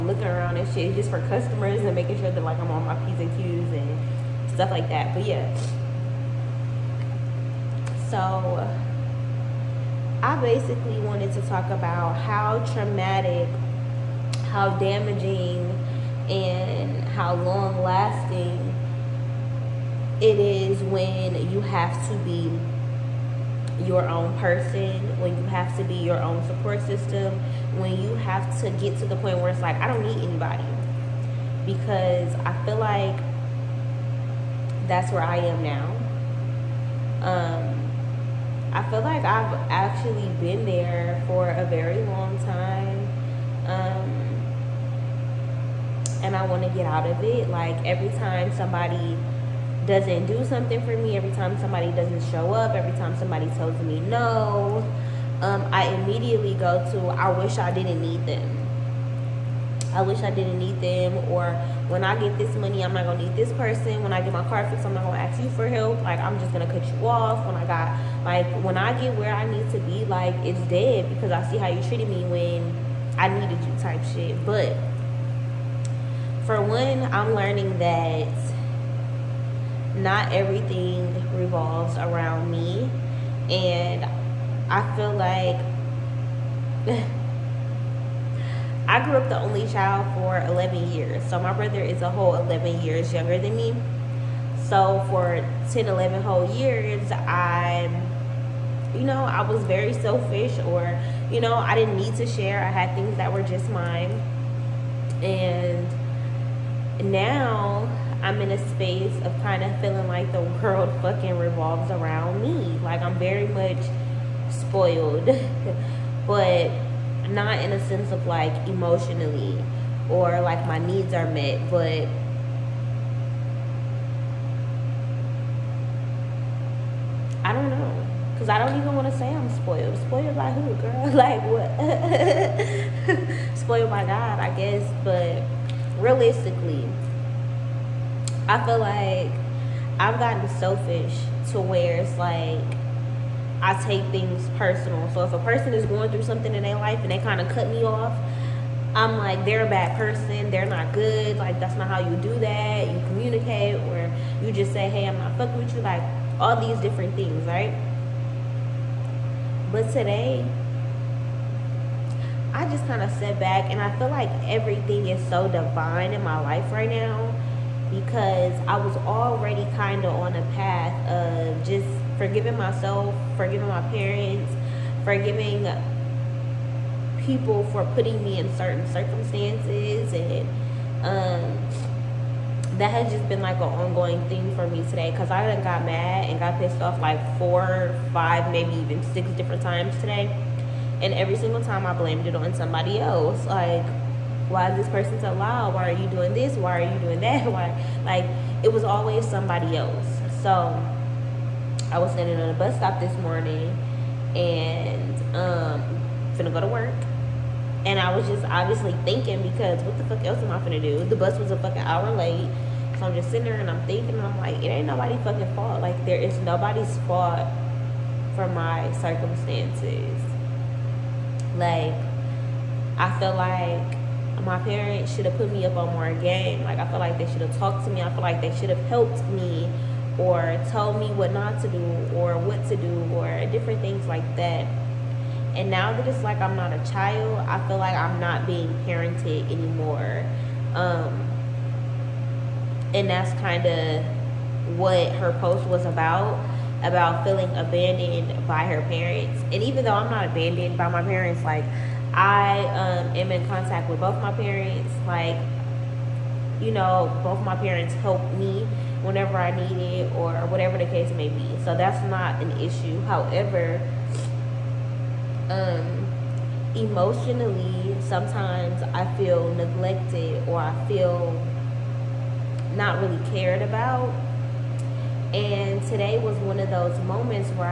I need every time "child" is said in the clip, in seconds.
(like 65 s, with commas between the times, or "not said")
89 s, 236 s.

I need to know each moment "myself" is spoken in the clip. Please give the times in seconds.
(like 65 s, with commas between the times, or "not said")
172 s.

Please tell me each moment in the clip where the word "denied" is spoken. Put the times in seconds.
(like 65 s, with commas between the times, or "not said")
not said.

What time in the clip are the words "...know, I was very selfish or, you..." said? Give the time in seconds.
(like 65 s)
99 s.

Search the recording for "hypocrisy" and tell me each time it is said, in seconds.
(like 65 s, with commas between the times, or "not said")
not said.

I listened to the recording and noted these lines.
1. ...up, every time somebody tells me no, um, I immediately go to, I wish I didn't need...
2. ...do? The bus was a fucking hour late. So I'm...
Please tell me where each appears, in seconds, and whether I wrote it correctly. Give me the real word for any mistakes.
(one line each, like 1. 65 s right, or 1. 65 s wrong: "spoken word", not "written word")
1. 52 s right
2. 210 s right.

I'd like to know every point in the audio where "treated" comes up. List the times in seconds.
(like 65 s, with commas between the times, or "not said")
71 s.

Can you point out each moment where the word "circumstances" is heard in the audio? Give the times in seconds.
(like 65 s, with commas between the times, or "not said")
178 s, 219 s.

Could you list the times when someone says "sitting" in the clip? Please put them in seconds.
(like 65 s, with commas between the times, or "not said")
213 s.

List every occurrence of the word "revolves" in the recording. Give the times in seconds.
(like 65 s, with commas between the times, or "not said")
81 s, 111 s.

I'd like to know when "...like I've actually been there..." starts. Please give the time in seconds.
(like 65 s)
39 s.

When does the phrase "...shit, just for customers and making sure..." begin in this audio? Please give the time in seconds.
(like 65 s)
0 s.